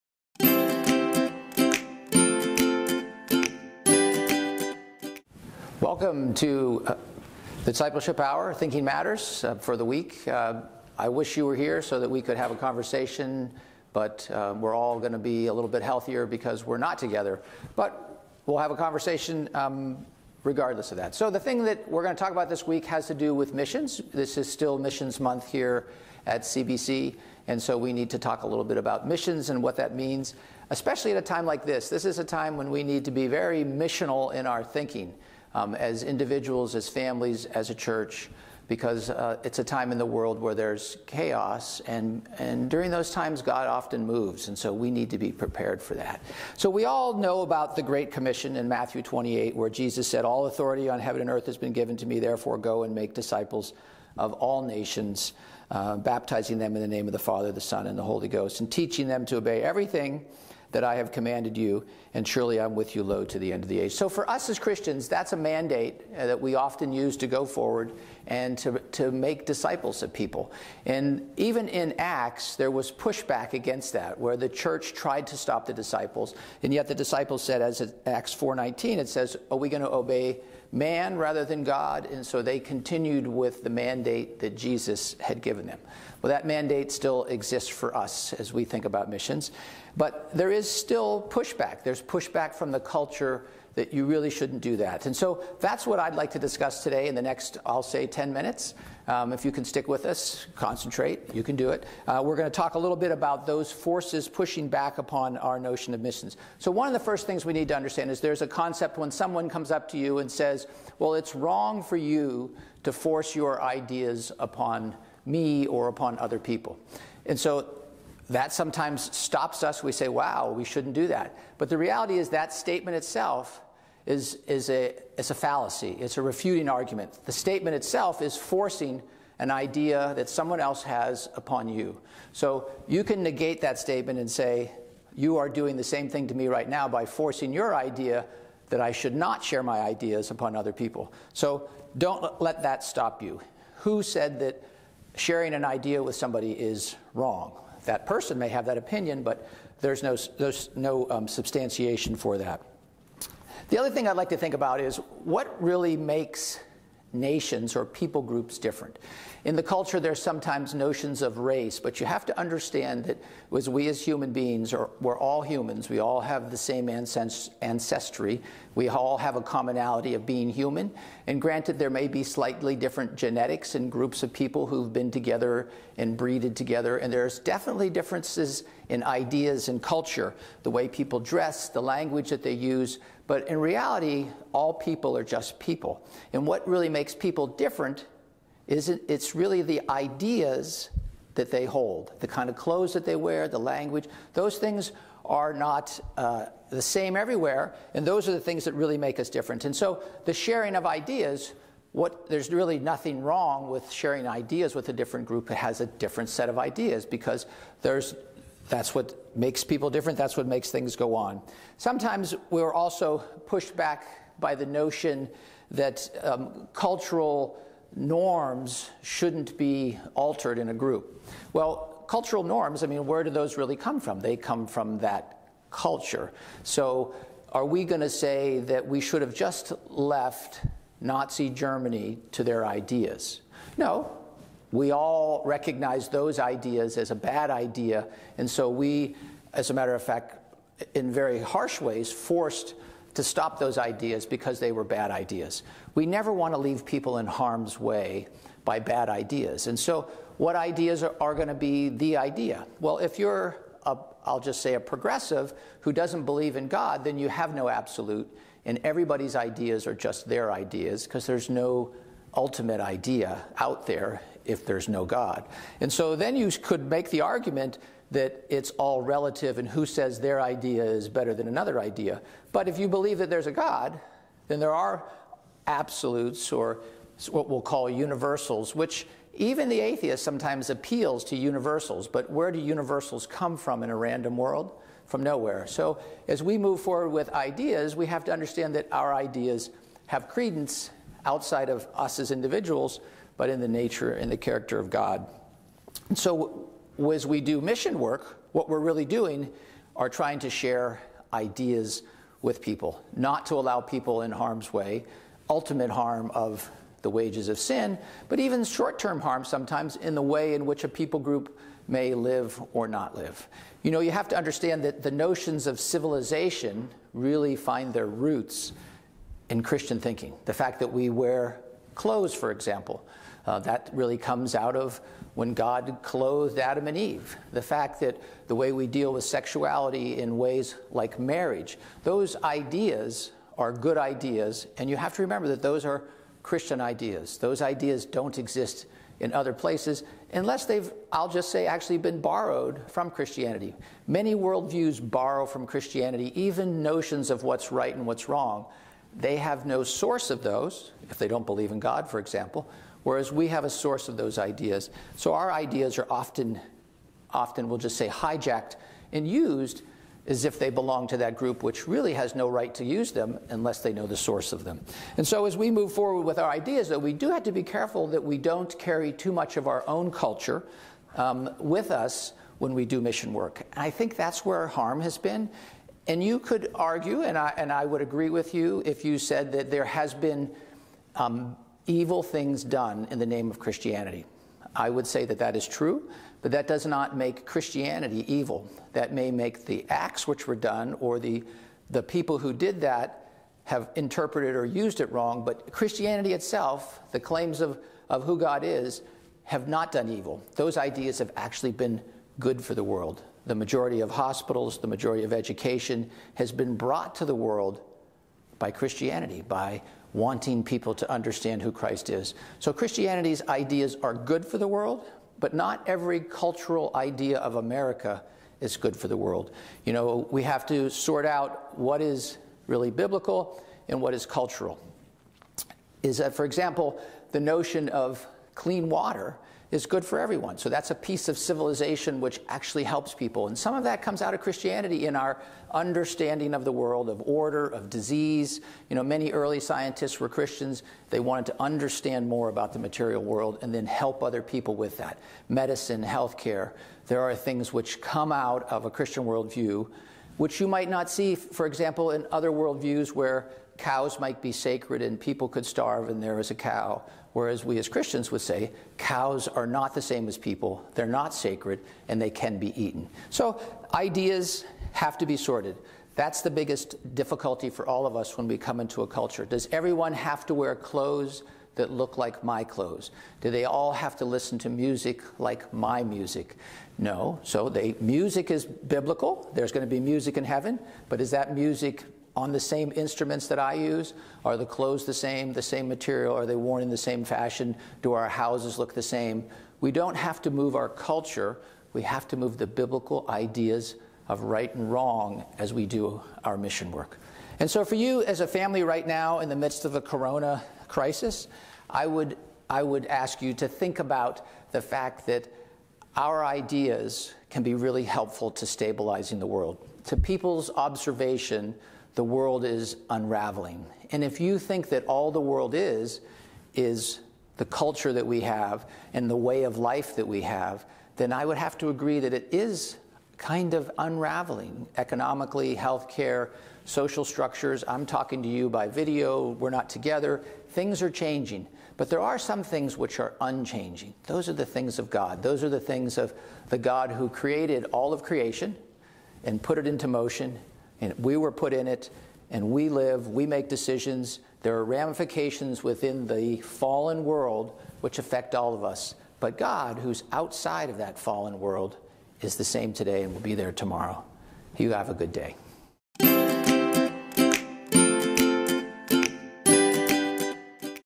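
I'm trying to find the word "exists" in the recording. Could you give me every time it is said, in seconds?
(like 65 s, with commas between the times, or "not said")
87 s, 338 s.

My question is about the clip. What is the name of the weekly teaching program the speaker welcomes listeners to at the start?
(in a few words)
Discipleship Hour.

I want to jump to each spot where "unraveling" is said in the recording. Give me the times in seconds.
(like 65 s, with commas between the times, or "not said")
513 s, 523 s.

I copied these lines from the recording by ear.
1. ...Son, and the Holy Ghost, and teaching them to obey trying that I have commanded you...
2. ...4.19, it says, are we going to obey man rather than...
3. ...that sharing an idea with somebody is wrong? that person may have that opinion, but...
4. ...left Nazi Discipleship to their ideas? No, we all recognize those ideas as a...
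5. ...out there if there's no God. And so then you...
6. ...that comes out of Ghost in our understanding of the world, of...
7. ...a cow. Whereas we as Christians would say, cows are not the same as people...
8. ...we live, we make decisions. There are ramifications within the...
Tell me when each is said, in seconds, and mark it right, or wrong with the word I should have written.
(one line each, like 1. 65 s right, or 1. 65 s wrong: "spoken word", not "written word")
1. 57 s wrong: "everything", not "trying"
2. 78 s right
3. 144 s right
4. 229 s wrong: "Germany", not "Discipleship"
5. 263 s right
6. 433 s wrong: "Christianity", not "Ghost"
7. 456 s right
8. 542 s right.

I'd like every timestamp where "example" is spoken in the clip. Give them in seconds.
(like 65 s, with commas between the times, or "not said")
322 s, 352 s, 426 s, 451 s.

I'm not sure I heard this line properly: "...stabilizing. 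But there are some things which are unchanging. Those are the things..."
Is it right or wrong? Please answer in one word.
wrong.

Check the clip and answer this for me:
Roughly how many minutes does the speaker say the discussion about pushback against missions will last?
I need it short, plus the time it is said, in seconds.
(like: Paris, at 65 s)
10, at 98 s.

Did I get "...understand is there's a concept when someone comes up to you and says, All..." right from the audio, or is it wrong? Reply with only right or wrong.
wrong.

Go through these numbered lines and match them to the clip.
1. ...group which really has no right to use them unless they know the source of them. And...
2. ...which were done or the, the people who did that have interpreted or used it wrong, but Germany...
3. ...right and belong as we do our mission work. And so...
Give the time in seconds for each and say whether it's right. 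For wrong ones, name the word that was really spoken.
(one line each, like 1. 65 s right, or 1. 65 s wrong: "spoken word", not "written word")
1. 361 s right
2. 390 s wrong: "Christianity", not "Germany"
3. 494 s wrong: "wrong", not "belong".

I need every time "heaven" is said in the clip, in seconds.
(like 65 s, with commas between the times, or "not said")
51 s, 480 s.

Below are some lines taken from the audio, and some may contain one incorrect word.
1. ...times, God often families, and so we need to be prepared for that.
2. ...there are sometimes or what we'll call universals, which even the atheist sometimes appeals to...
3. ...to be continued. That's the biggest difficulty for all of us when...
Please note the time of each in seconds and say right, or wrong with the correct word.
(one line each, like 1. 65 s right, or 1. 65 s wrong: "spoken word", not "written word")
1. 43 s wrong: "moves", not "families"
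2. 274 s wrong: "absolutes", not "sometimes"
3. 465 s wrong: "sorted", not "continued".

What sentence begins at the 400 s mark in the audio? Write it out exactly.
Those ideas have actually been good for the world.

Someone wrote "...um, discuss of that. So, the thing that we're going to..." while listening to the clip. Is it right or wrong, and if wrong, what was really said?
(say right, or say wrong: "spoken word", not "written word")
wrong: "regardless", not "discuss".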